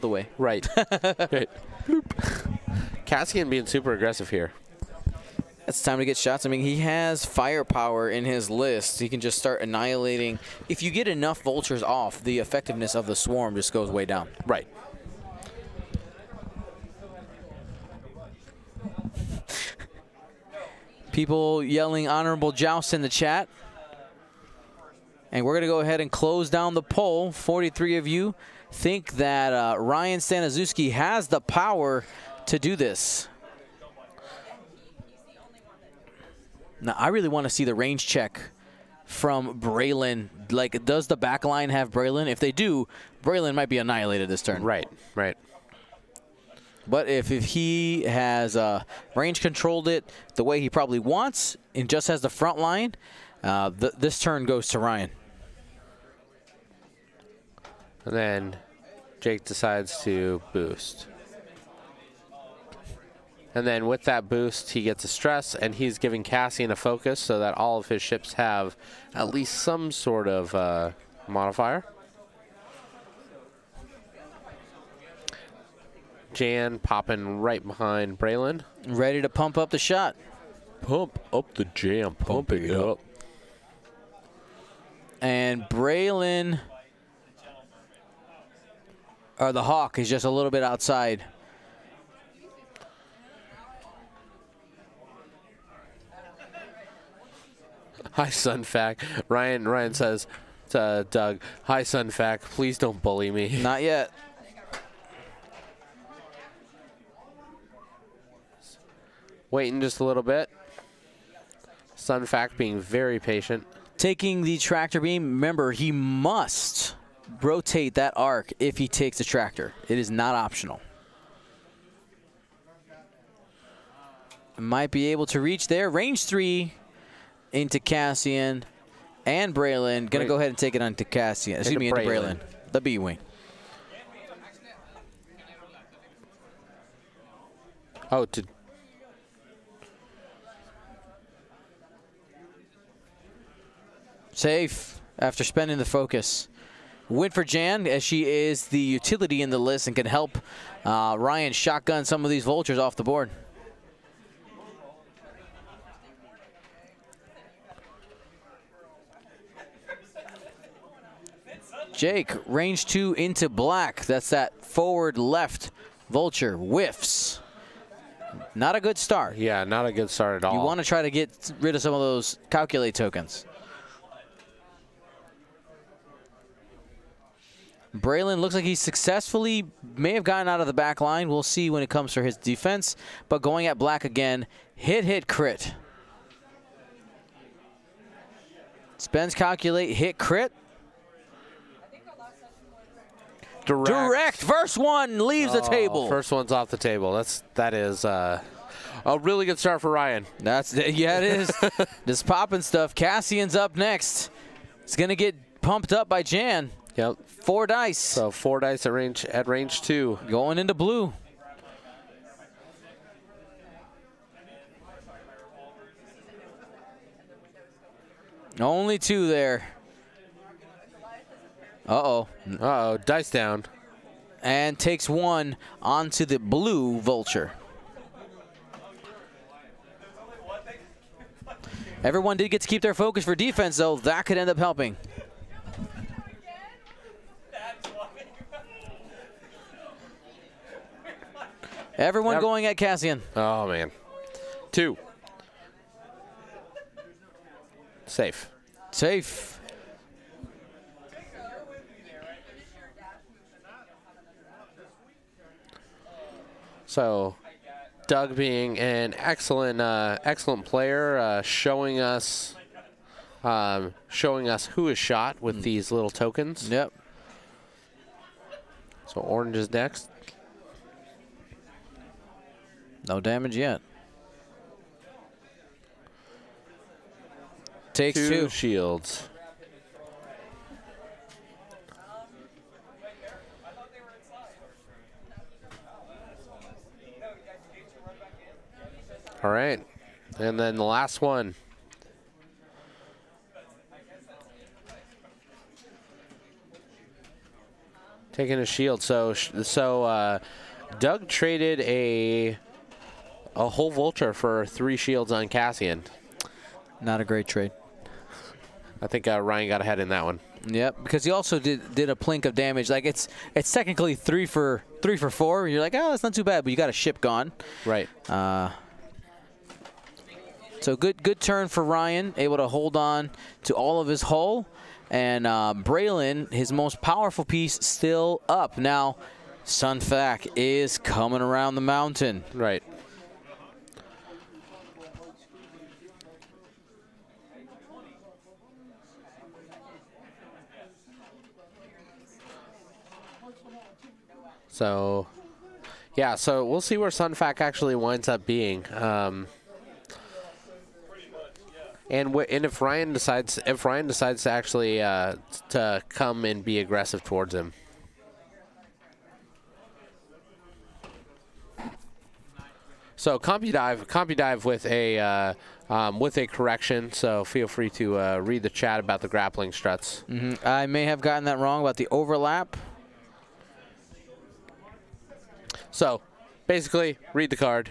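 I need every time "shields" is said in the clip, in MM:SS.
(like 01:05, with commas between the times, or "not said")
04:38, 04:58, 05:04.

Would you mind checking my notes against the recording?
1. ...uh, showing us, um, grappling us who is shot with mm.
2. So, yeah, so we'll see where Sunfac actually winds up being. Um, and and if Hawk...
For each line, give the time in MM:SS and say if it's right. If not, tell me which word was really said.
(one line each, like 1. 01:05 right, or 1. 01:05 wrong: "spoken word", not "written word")
1. 04:21 wrong: "showing", not "grappling"
2. 05:44 wrong: "Ryan", not "Hawk".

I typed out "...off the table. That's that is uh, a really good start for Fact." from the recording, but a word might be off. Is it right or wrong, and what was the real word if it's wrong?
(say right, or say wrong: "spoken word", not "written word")
wrong: "Ryan", not "Fact".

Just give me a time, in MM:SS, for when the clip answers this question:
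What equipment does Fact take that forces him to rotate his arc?
01:54.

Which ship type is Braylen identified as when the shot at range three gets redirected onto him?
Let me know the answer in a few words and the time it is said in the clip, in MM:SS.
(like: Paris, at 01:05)
B-Wing, at 02:12.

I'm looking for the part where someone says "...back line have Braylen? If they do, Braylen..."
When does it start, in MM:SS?
00:41.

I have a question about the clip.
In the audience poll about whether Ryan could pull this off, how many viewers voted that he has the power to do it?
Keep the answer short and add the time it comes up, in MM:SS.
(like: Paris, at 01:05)
43, at 00:27.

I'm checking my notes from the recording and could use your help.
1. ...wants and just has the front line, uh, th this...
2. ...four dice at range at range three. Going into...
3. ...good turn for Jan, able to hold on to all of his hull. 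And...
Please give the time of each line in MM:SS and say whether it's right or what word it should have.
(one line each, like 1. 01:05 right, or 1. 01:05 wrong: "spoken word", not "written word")
1. 00:50 right
2. 03:28 wrong: "two", not "three"
3. 05:21 wrong: "Ryan", not "Jan".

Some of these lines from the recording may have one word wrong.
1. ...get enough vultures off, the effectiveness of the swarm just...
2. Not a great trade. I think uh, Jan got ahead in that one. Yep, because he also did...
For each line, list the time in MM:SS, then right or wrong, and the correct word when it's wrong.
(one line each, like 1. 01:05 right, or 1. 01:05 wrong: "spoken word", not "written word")
1. 00:10 right
2. 05:07 wrong: "Ryan", not "Jan".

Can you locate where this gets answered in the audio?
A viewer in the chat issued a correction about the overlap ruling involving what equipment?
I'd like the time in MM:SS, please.
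06:09.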